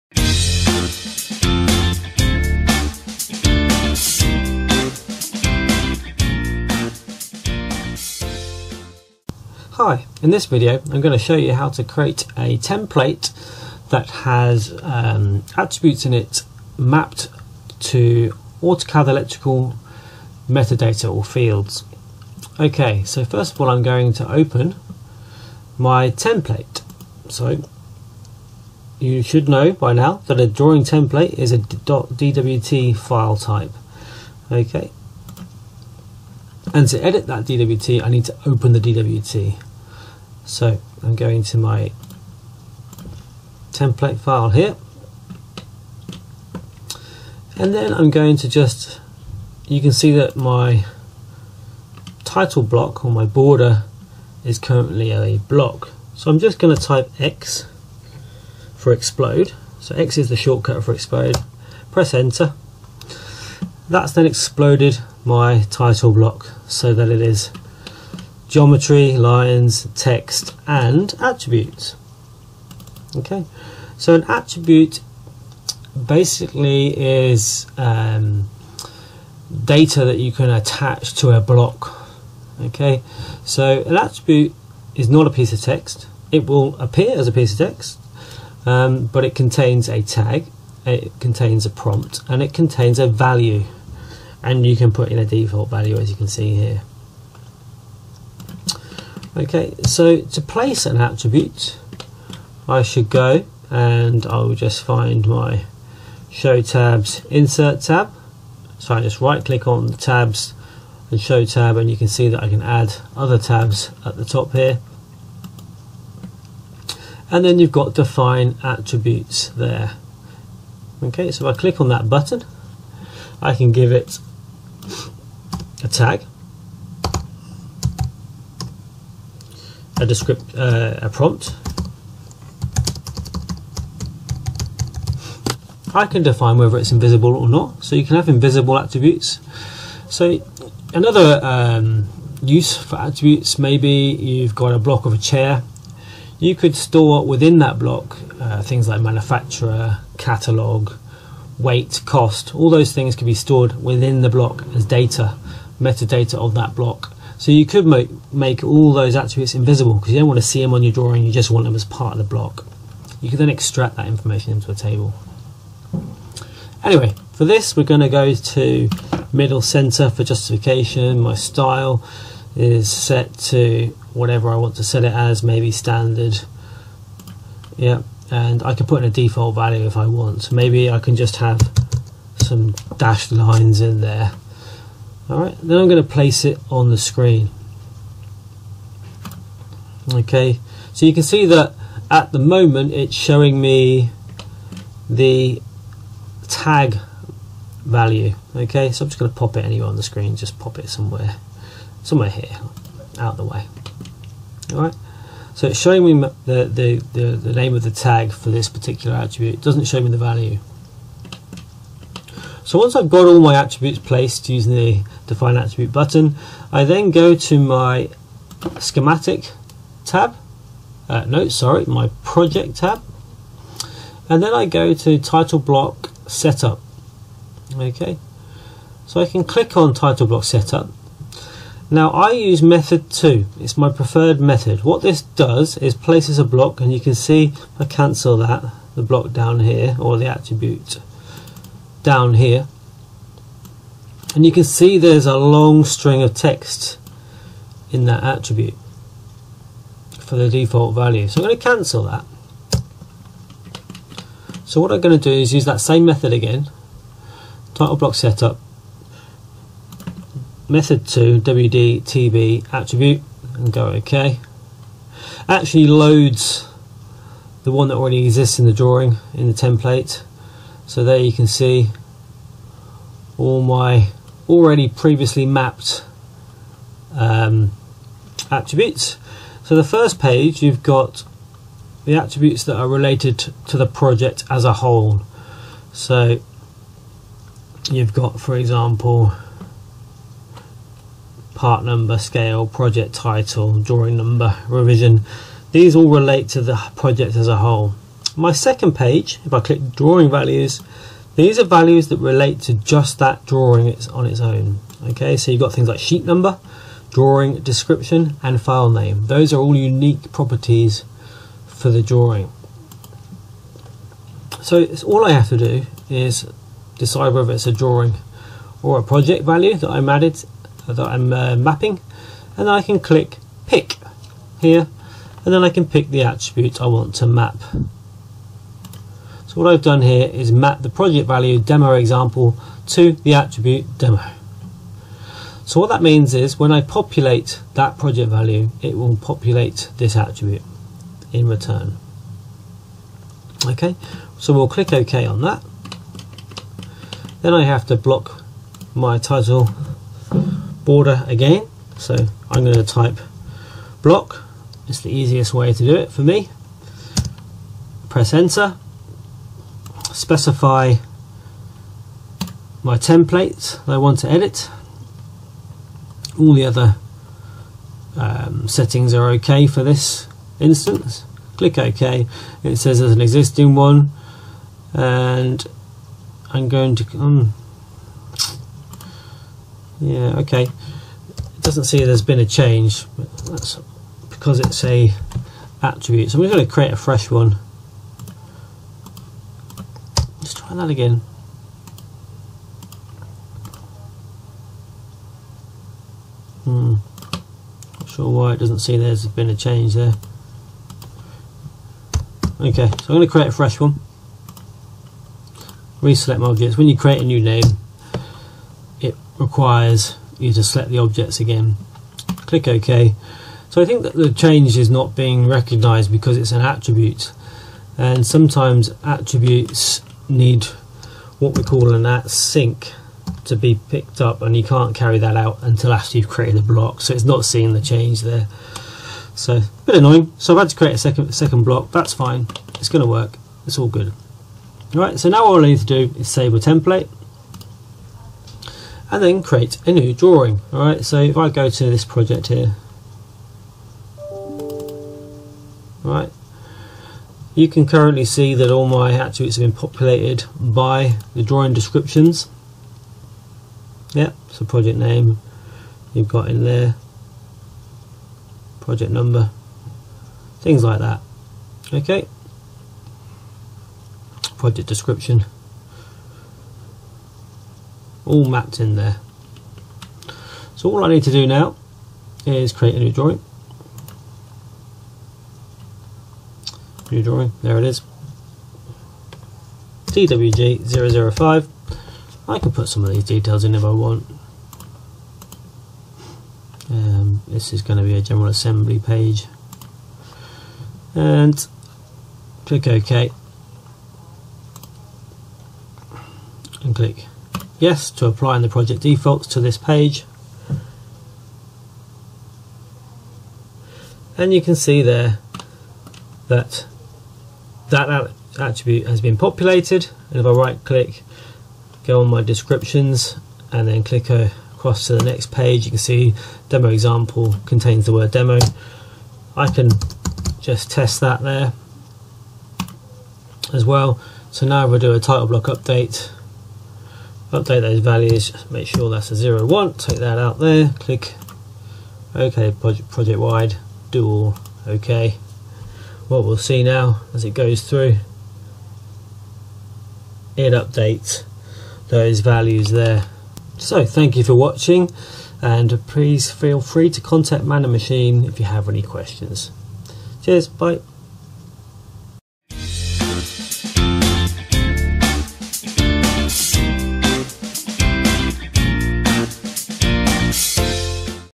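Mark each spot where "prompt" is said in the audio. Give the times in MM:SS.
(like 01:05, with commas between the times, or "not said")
01:31, 02:11.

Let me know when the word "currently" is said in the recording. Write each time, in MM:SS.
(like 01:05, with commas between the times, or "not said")
00:54, 07:27.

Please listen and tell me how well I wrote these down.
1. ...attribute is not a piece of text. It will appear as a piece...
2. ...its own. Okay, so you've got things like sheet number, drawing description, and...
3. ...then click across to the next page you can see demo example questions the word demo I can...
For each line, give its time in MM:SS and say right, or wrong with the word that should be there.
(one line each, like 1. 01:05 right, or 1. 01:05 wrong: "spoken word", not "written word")
1. 01:23 right
2. 05:04 right
3. 08:33 wrong: "contains", not "questions".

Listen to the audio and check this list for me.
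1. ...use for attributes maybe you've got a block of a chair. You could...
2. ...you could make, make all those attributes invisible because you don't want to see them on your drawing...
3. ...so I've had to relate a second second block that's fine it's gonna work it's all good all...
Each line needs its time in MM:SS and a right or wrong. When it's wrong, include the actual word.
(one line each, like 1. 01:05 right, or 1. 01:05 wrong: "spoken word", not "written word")
1. 02:22 right
2. 02:37 right
3. 07:10 wrong: "create", not "relate".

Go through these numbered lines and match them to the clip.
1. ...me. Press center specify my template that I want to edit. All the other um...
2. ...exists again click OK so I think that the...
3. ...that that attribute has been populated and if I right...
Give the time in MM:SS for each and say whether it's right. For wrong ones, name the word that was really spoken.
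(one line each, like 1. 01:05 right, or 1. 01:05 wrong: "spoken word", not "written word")
1. 05:56 wrong: "enter", not "center"
2. 06:50 wrong: "objects", not "exists"
3. 08:26 right.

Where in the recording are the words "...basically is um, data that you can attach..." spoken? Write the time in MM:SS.
01:16.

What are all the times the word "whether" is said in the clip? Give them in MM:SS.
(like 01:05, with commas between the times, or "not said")
02:16, 05:17.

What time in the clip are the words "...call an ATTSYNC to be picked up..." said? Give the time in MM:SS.
07:01.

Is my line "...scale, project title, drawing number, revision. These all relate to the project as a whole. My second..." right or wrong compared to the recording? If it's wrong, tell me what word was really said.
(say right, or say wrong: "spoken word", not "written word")
right.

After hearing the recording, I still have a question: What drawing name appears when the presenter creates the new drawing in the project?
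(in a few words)
TWG005.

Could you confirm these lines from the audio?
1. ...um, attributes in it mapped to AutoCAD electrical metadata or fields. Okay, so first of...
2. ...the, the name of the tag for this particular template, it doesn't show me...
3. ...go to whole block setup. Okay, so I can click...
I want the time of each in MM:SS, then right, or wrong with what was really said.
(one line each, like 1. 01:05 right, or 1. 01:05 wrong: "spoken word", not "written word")
1. 00:14 right
2. 03:27 wrong: "attribute", not "template"
3. 03:44 wrong: "title", not "whole".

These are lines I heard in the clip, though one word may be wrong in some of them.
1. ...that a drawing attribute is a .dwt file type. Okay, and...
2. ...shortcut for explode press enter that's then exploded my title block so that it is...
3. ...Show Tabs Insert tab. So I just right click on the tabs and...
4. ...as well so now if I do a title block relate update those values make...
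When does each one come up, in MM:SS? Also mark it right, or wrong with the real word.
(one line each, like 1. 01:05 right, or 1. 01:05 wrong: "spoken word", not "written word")
1. 00:30 wrong: "template", not "attribute"
2. 01:00 right
3. 01:46 right
4. 08:43 wrong: "update", not "relate".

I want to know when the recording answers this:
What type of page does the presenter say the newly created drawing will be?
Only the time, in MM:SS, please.
08:08.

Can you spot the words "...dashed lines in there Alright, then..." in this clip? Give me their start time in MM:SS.
03:02.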